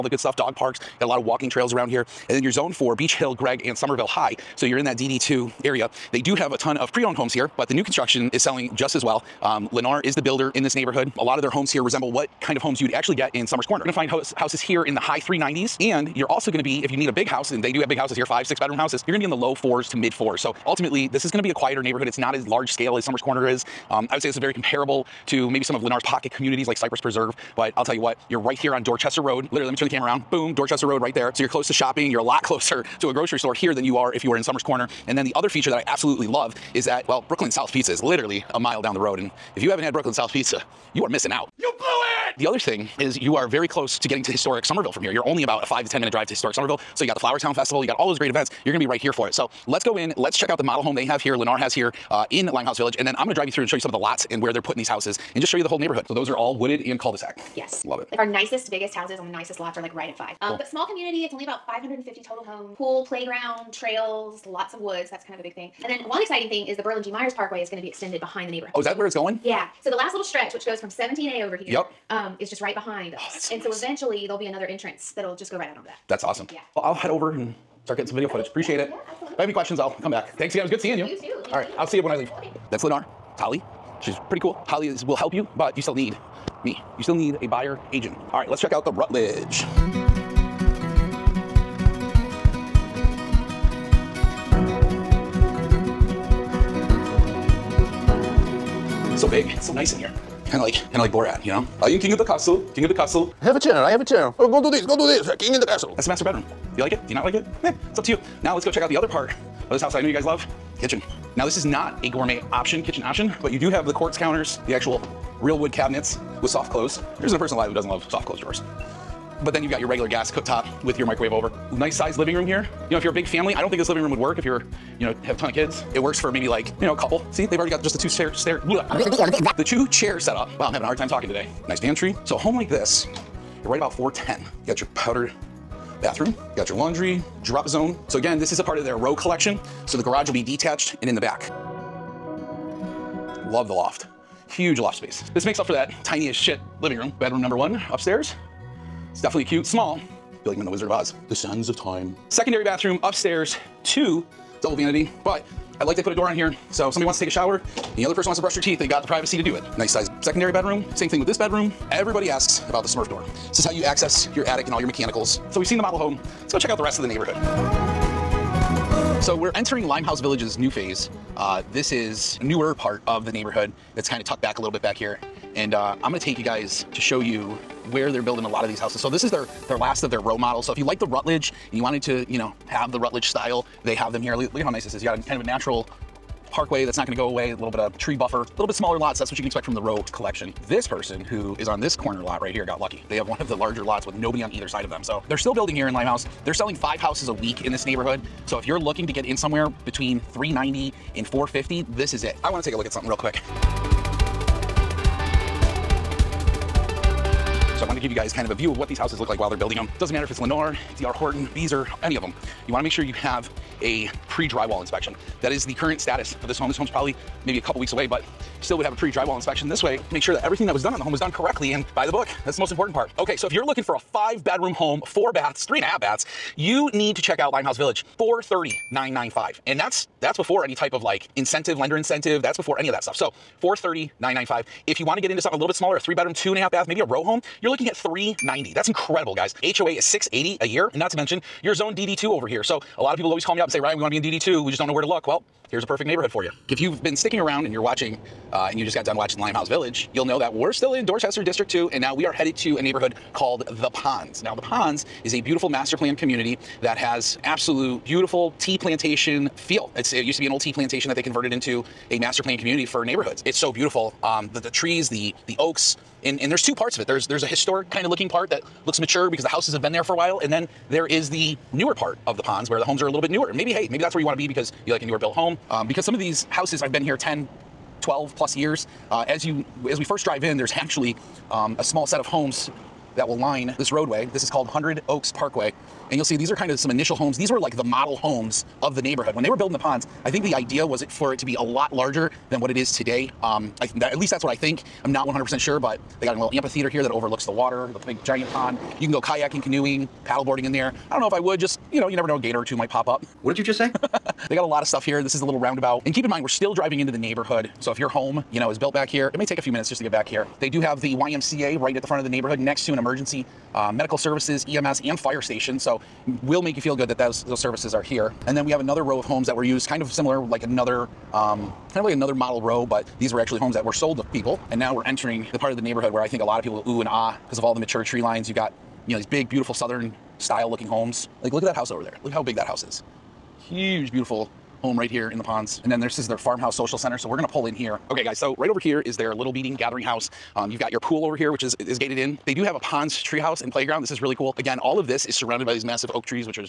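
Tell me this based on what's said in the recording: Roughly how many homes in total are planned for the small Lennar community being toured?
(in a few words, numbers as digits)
550.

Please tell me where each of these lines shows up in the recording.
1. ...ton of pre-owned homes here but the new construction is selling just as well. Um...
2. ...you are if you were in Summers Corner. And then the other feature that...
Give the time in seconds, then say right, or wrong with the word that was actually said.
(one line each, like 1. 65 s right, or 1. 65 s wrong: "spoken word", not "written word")
1. 6 s right
2. 33 s right.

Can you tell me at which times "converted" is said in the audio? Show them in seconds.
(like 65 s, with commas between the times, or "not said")
261 s.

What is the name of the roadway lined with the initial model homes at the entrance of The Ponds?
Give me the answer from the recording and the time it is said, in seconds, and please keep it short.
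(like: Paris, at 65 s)
Hundred Oaks Parkway, at 284 s.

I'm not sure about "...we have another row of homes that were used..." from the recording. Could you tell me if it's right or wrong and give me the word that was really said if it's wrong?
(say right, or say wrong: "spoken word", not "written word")
right.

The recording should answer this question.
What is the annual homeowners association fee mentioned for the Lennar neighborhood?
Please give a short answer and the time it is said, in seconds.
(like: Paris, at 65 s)
680 a year, at 239 s.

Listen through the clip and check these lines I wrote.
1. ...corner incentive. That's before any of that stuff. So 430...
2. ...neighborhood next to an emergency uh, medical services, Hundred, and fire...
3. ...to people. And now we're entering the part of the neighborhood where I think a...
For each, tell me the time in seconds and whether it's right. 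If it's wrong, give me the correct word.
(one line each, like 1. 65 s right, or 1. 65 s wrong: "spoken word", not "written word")
1. 231 s wrong: "lender", not "corner"
2. 312 s wrong: "EMS", not "Hundred"
3. 324 s right.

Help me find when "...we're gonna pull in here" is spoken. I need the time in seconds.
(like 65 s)
337 s.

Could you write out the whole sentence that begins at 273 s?
And maybe, hey, maybe that's where you want to be because you like a newer built home.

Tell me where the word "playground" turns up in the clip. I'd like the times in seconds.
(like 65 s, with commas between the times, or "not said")
63 s, 343 s.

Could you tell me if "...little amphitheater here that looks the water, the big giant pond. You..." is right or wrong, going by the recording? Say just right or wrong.
wrong.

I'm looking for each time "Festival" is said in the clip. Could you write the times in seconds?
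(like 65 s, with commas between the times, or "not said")
47 s.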